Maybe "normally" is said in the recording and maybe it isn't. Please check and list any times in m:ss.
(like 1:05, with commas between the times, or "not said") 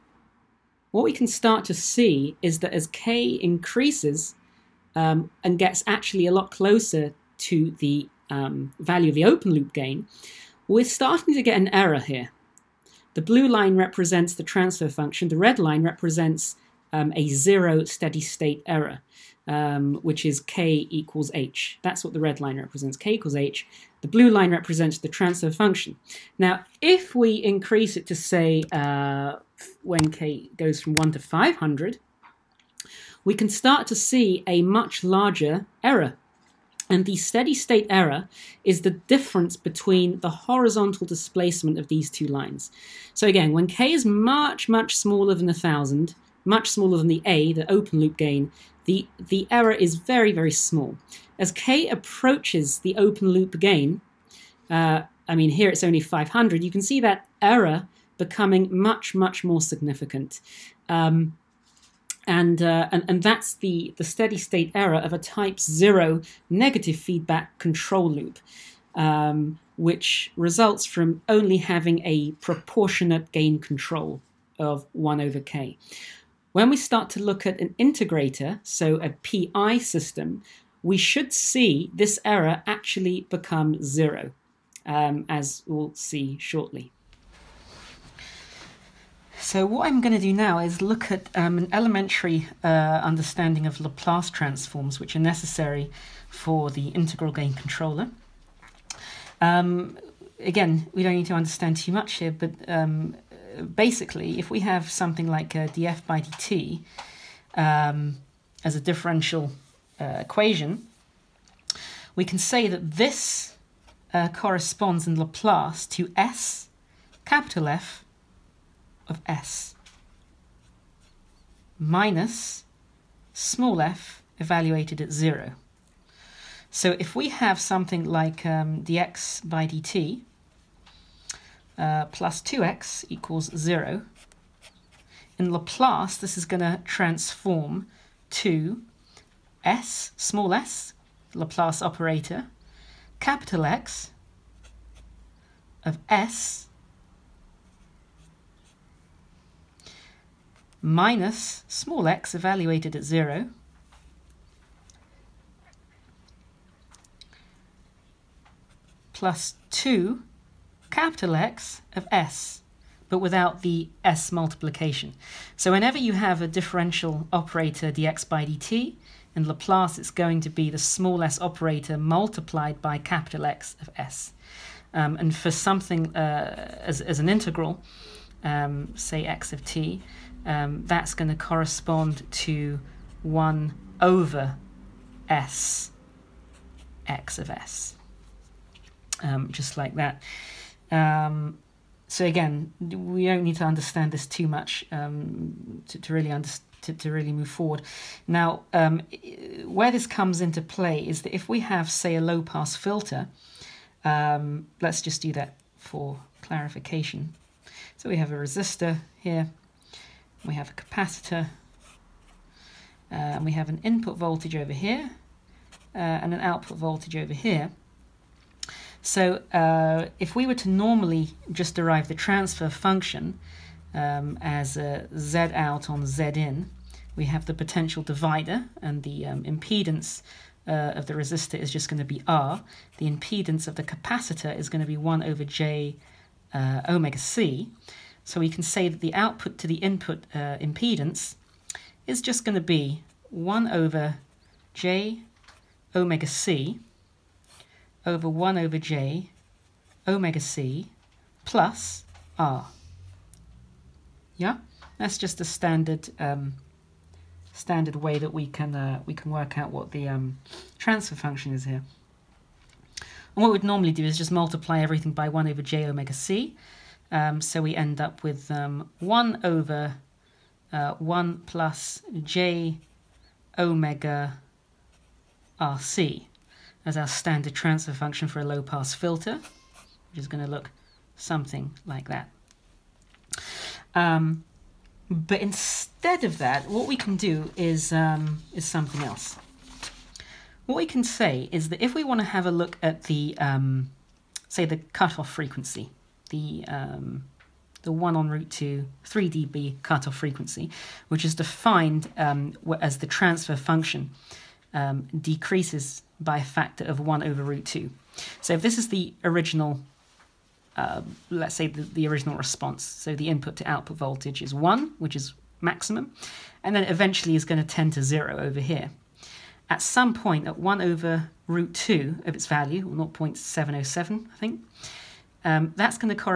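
3:40, 4:23.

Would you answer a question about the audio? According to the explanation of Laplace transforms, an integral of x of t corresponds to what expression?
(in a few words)
1 over s X of s.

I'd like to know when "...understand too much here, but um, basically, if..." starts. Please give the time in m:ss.
1:41.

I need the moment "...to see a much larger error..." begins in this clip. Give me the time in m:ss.
0:33.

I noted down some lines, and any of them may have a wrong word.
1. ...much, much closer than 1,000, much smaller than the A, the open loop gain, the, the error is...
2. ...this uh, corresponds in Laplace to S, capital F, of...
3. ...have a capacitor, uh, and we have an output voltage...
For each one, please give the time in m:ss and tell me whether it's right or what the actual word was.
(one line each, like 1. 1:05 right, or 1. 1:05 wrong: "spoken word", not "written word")
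1. 0:44 wrong: "smaller", not "closer"
2. 1:52 right
3. 3:30 wrong: "input", not "output".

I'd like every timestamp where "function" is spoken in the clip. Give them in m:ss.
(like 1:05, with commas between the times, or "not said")
0:14, 0:25, 3:42, 4:21, 4:37, 5:03.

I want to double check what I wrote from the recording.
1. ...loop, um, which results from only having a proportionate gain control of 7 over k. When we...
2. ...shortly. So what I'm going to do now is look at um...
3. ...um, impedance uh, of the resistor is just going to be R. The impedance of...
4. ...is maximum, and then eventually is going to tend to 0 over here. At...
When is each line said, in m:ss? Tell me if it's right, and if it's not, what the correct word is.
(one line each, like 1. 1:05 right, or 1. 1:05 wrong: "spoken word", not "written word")
1. 1:08 wrong: "1", not "7"
2. 1:26 right
3. 3:49 right
4. 5:15 right.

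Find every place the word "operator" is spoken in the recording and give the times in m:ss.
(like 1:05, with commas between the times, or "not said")
2:21, 2:47, 2:51.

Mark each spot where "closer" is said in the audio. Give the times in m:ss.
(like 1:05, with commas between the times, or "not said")
0:06.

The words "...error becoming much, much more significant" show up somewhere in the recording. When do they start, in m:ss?
0:57.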